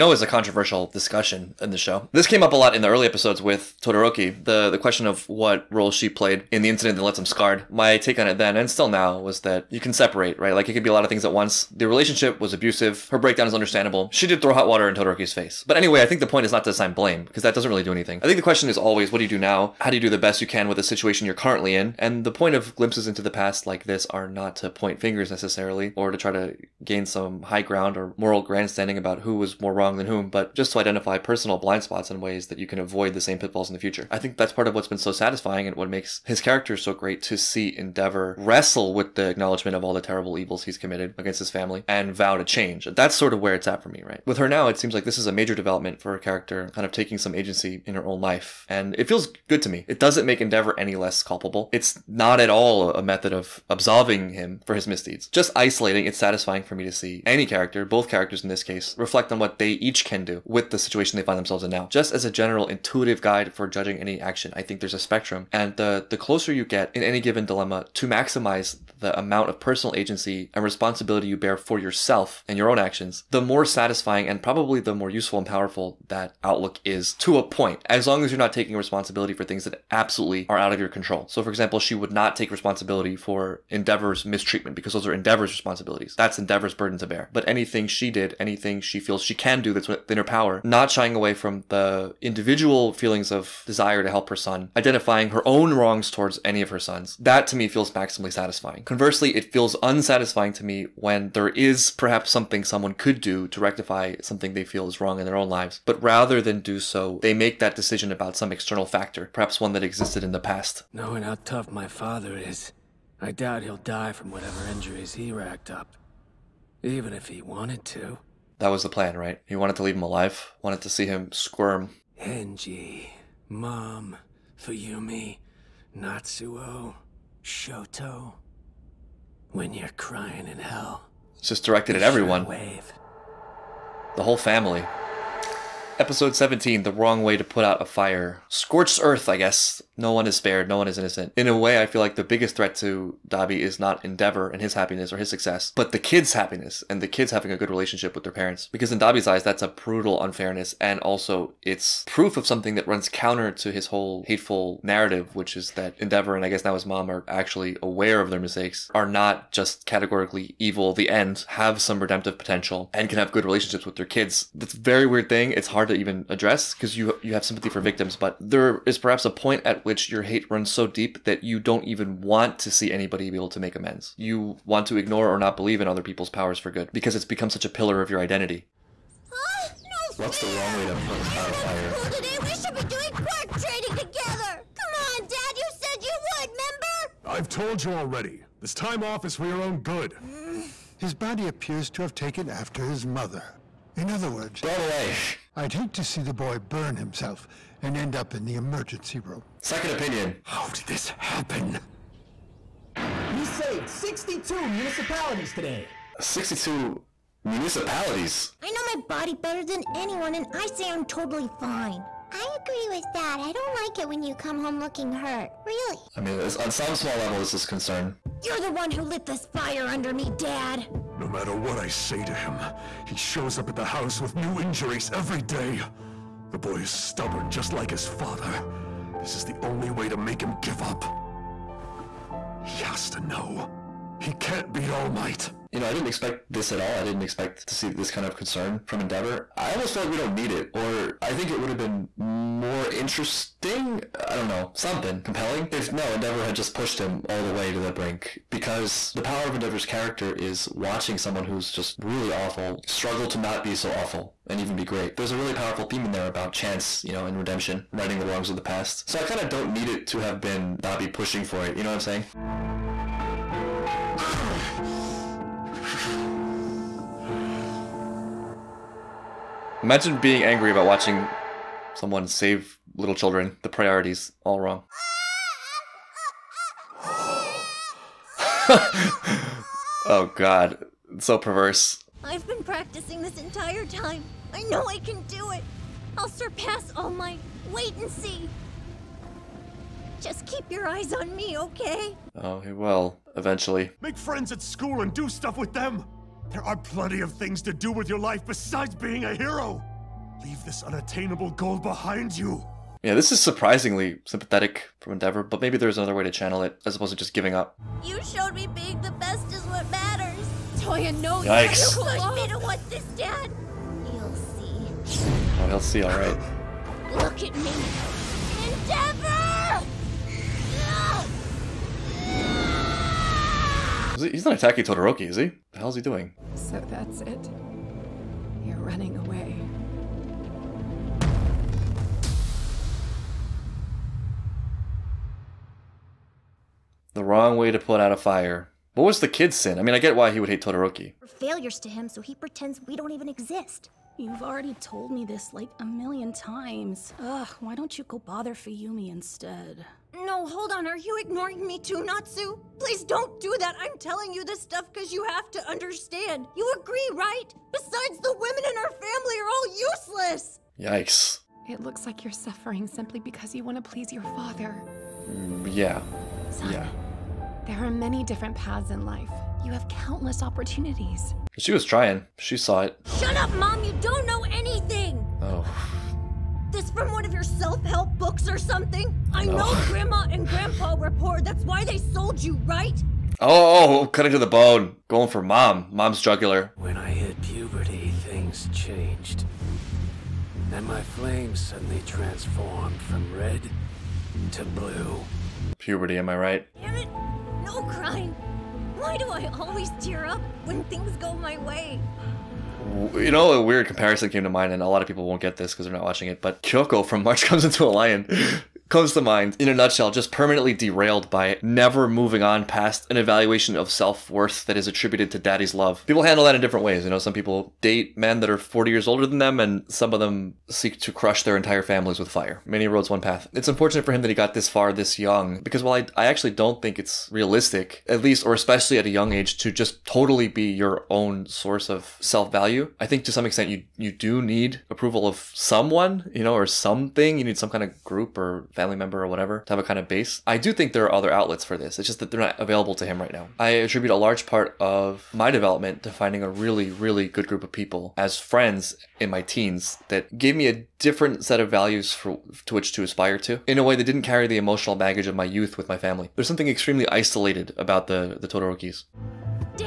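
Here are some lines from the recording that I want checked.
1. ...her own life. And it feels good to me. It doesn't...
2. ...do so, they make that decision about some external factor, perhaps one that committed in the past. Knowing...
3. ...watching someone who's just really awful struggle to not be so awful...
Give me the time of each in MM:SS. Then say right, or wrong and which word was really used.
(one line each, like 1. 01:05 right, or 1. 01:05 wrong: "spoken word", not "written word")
1. 00:47 right
2. 01:46 wrong: "existed", not "committed"
3. 04:10 right.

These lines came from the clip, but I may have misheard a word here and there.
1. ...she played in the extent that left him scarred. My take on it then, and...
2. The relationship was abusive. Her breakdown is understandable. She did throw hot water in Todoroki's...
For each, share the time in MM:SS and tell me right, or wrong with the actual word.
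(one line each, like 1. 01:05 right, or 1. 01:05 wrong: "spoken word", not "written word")
1. 00:05 wrong: "incident", not "extent"
2. 00:11 right.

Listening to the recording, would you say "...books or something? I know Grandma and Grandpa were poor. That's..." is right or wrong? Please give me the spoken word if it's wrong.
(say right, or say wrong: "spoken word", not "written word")
right.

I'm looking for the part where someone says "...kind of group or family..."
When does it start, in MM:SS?
07:17.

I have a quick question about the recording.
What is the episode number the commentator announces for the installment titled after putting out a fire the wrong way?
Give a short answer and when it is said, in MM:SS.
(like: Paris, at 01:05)
17, at 02:15.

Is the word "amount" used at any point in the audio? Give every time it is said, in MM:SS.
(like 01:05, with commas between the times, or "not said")
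01:09.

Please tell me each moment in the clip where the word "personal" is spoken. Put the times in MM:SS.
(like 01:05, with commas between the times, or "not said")
00:31, 01:09.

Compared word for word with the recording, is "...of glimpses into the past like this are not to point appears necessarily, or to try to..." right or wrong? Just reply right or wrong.
wrong.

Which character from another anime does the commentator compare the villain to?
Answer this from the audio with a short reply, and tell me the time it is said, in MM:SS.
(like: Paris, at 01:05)
Kyoko, at 06:46.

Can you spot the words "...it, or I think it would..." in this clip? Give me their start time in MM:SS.
04:00.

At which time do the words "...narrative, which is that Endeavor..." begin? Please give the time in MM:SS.
02:34.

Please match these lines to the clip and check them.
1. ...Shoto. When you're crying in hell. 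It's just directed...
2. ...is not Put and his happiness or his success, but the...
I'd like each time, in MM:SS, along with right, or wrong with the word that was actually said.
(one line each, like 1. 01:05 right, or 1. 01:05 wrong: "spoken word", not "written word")
1. 02:07 right
2. 02:23 wrong: "Endeavor", not "Put".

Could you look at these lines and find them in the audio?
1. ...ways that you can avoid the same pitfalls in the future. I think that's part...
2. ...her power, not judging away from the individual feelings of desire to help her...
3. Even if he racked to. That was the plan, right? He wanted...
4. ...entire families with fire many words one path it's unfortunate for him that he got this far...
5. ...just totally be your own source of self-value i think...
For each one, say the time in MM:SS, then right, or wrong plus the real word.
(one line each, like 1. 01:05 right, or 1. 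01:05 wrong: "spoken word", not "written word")
1. 00:32 right
2. 01:30 wrong: "shying", not "judging"
3. 01:56 wrong: "wanted", not "racked"
4. 07:01 wrong: "roads", not "words"
5. 07:09 right.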